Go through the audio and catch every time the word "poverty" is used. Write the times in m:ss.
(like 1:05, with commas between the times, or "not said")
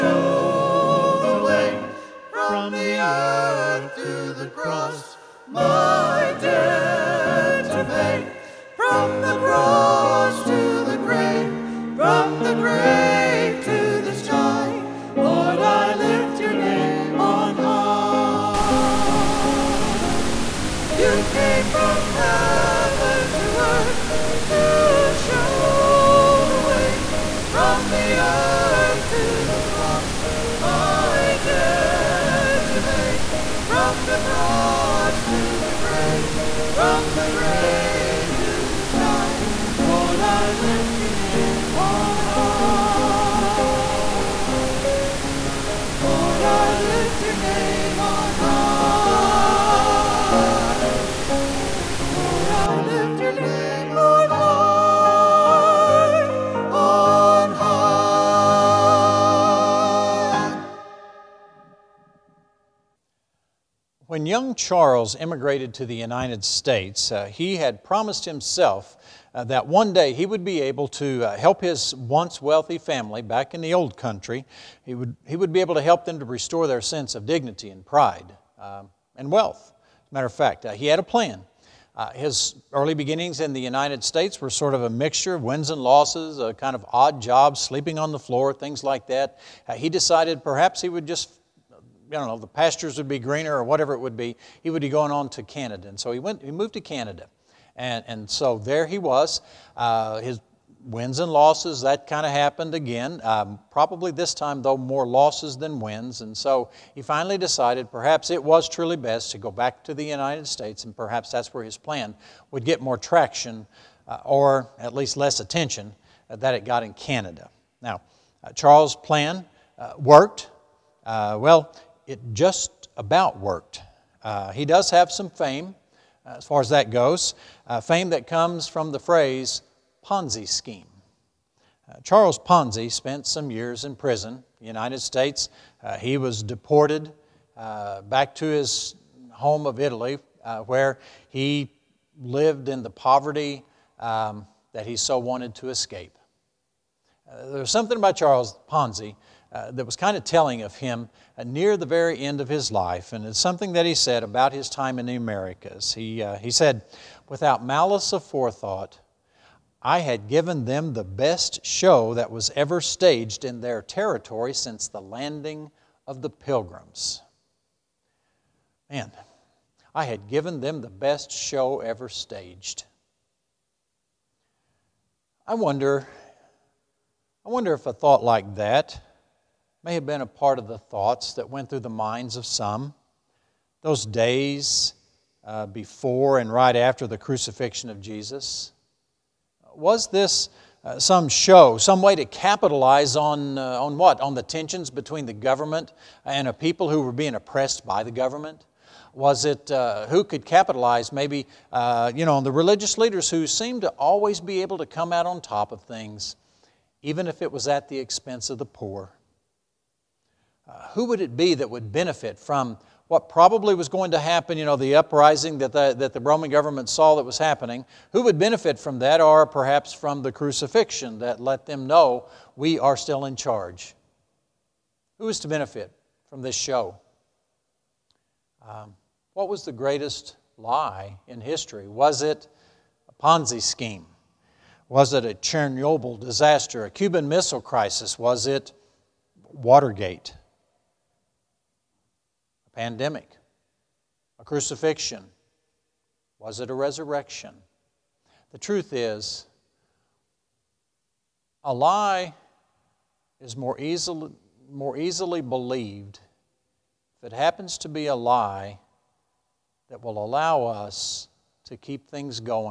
2:22.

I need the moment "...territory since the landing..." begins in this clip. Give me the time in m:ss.
2:43.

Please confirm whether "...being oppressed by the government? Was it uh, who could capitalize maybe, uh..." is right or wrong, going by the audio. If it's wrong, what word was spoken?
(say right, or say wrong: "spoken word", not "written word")
right.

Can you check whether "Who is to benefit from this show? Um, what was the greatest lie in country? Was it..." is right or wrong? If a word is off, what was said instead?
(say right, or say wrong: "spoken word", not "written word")
wrong: "history", not "country".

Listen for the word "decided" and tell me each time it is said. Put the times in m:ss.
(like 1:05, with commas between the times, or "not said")
1:29, 1:47.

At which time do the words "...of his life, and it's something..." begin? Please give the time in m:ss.
2:32.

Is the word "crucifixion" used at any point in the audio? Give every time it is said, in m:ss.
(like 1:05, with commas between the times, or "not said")
3:07, 3:40, 4:04.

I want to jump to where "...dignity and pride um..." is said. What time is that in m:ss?
1:17.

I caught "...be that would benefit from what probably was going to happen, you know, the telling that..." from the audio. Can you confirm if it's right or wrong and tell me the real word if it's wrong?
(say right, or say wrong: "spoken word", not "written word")
wrong: "uprising", not "telling".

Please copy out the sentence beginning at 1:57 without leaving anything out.
Now, uh, Charles' plan uh, worked.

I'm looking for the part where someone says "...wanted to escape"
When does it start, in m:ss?
2:25.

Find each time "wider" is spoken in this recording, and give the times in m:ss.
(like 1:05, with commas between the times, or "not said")
not said.